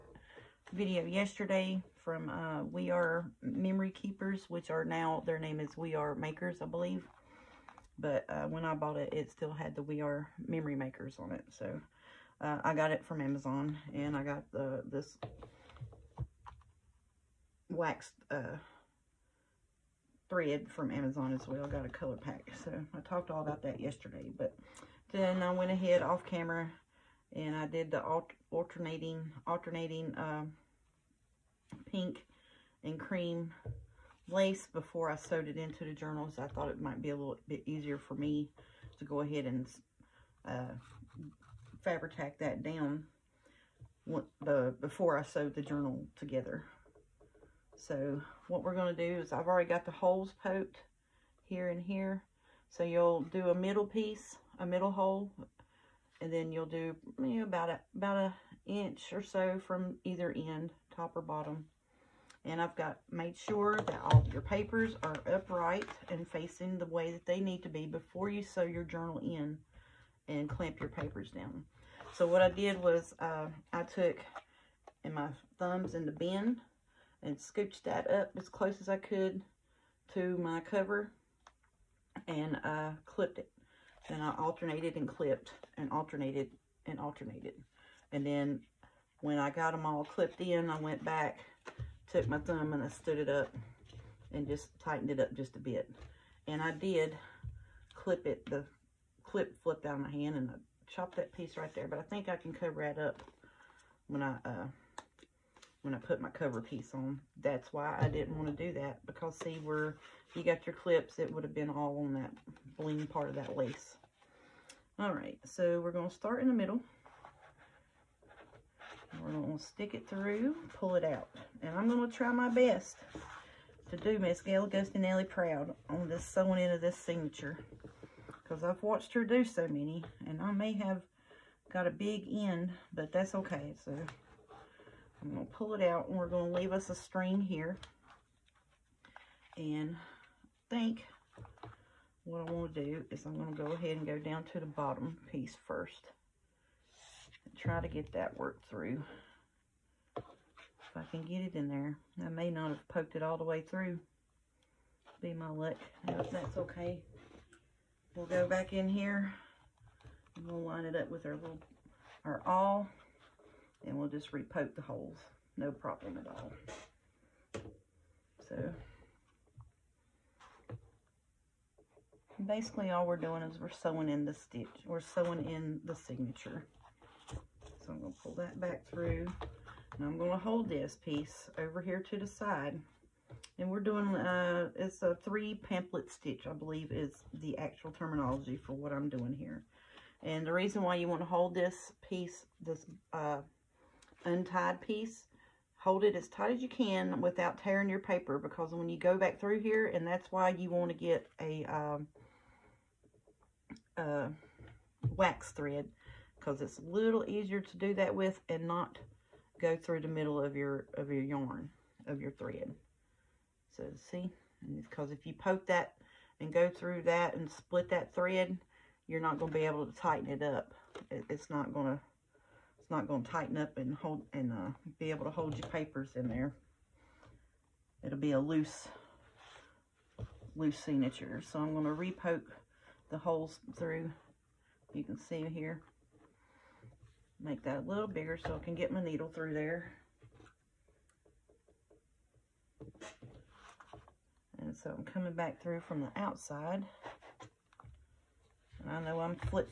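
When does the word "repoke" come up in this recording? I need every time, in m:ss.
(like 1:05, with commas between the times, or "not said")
2:44, 3:51.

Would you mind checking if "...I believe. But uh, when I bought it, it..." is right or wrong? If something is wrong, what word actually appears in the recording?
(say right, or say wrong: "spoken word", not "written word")
right.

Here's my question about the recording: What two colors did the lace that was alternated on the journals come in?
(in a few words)
pink and cream.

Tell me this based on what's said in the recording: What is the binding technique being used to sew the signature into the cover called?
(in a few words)
three pamphlet stitch.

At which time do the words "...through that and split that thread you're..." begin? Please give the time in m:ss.
3:36.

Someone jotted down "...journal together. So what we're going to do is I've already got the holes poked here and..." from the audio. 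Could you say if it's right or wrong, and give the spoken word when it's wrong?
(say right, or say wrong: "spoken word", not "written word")
right.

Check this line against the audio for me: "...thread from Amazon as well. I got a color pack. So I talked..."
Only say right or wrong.
right.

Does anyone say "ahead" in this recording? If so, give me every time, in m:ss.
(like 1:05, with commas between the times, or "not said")
0:25, 0:39, 2:23.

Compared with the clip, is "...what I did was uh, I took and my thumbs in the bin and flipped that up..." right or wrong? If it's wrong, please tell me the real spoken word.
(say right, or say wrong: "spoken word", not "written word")
wrong: "scooched", not "flipped".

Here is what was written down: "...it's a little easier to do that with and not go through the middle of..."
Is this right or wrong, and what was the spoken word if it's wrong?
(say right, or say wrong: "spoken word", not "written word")
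right.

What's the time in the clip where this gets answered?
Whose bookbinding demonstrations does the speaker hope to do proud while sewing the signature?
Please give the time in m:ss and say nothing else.
2:04.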